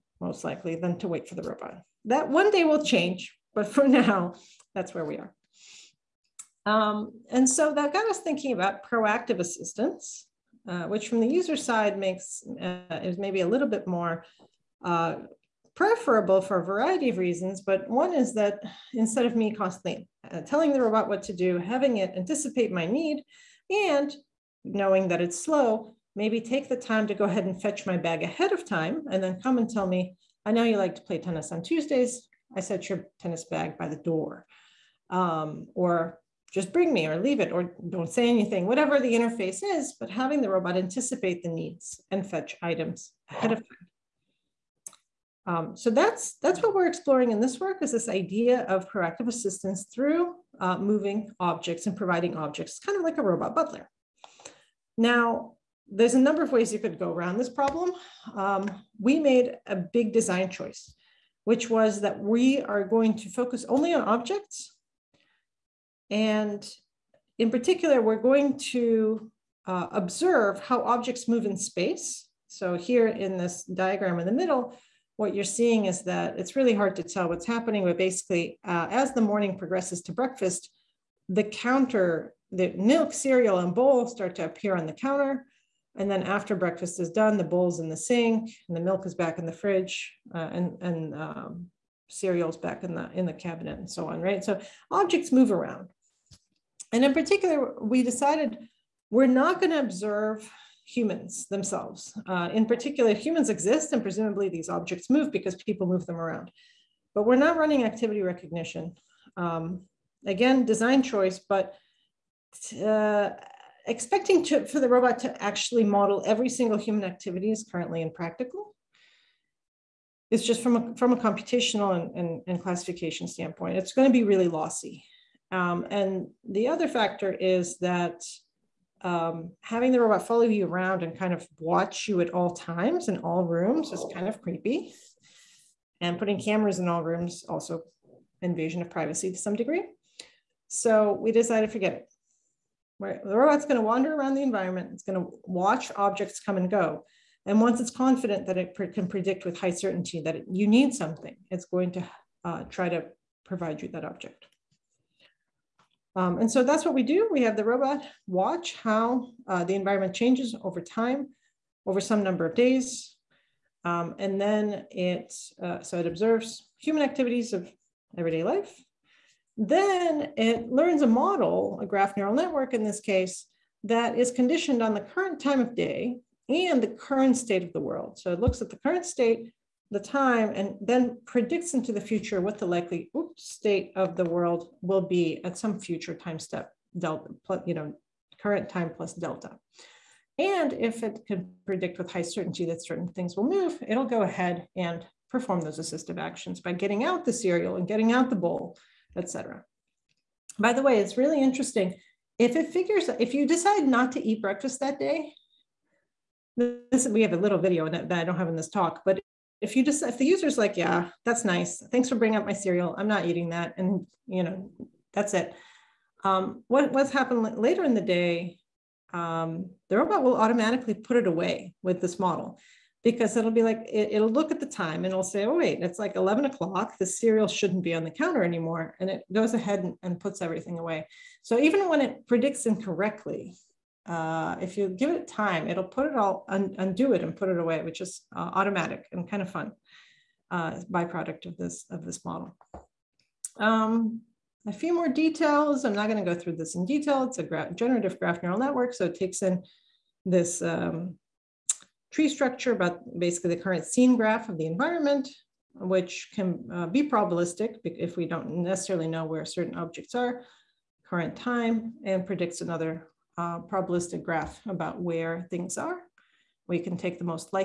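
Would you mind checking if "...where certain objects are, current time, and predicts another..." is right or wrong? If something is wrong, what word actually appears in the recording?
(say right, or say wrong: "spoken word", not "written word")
right.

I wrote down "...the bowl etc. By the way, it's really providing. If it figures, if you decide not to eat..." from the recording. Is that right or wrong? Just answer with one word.
wrong.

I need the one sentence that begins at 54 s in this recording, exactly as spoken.
Now, there's a number of ways you could go around this problem.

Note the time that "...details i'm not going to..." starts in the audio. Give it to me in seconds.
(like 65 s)
245 s.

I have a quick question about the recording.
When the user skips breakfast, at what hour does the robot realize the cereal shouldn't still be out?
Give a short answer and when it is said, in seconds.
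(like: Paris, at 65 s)
11 o'clock, at 226 s.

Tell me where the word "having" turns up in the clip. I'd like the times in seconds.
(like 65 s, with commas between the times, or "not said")
21 s, 40 s, 129 s.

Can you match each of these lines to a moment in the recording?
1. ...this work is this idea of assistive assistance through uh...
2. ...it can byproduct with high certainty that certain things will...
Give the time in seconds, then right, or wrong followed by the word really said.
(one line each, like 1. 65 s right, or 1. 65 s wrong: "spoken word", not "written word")
1. 47 s wrong: "proactive", not "assistive"
2. 191 s wrong: "predict", not "byproduct".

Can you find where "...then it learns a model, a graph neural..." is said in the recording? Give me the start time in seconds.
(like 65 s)
169 s.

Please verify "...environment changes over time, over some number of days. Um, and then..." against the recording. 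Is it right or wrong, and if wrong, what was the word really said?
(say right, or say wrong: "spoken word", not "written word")
right.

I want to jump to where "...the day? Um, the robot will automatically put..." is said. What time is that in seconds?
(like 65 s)
217 s.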